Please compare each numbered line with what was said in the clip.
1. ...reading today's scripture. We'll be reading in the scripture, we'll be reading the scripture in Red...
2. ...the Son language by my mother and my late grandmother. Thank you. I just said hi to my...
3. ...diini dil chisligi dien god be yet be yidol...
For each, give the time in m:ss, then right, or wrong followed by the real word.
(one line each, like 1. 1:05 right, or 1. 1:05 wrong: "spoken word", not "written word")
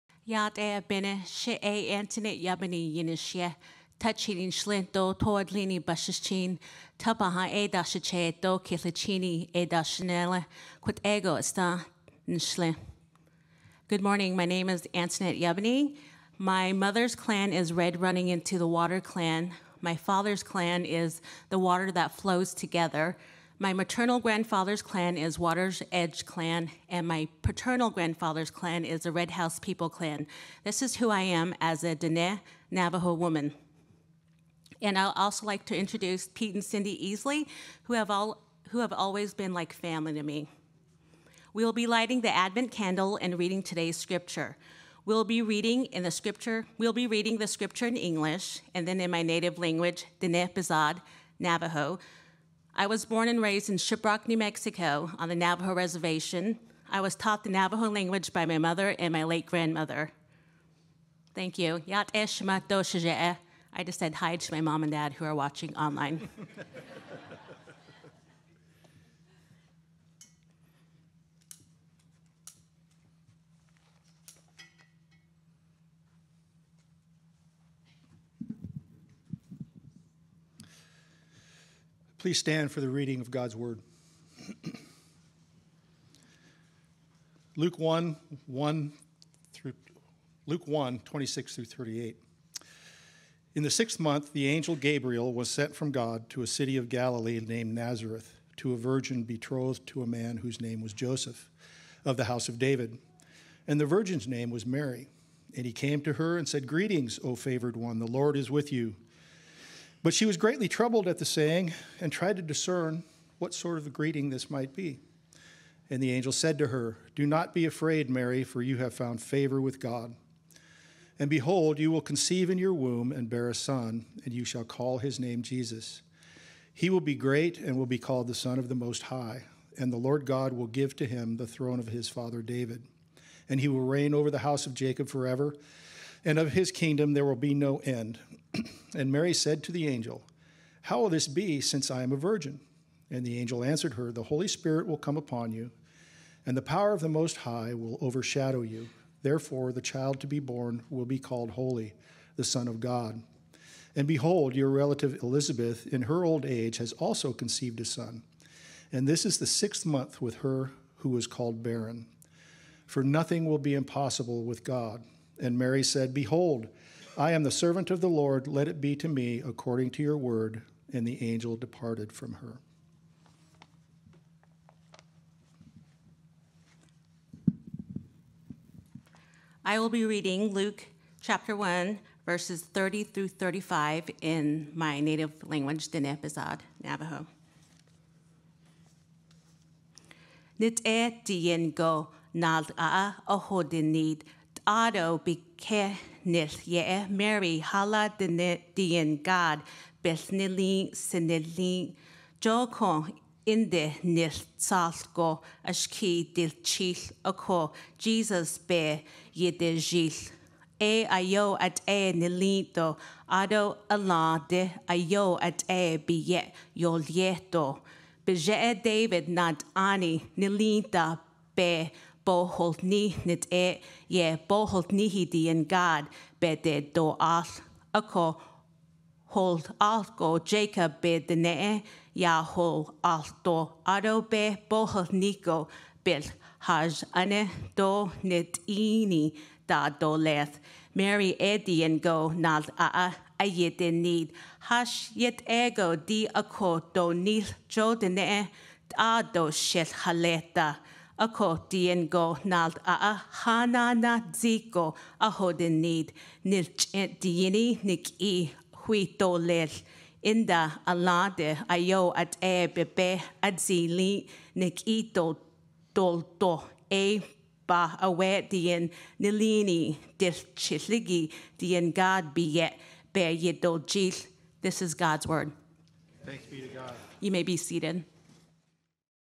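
1. 0:43 wrong: "English", not "Red"
2. 0:57 wrong: "Navajo", not "Son"
3. 4:29 wrong: "nilini", not "diini".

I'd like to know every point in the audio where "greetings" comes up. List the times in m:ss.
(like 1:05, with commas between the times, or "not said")
1:46, 1:53.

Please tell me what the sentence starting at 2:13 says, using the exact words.
And he will reign over the house of Jacob forever and of his kingdom there will be no end.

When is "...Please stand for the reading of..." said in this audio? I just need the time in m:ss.
1:22.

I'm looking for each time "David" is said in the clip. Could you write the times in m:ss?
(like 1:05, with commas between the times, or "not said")
1:42, 2:12, 3:38.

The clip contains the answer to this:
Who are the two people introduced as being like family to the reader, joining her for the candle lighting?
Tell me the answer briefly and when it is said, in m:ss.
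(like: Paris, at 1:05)
Pete and Cindy Easley, at 0:36.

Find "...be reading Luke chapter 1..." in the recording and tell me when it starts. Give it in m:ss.
2:59.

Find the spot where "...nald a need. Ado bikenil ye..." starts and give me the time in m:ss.
3:12.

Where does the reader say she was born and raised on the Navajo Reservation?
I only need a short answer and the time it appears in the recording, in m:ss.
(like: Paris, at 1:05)
Shiprock, New Mexico, at 0:53.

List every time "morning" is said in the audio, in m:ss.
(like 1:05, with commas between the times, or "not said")
0:14.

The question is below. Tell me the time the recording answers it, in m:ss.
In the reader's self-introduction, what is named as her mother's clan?
0:17.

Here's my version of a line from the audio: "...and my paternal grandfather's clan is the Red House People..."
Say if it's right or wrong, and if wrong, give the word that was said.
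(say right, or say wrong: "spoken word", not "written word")
right.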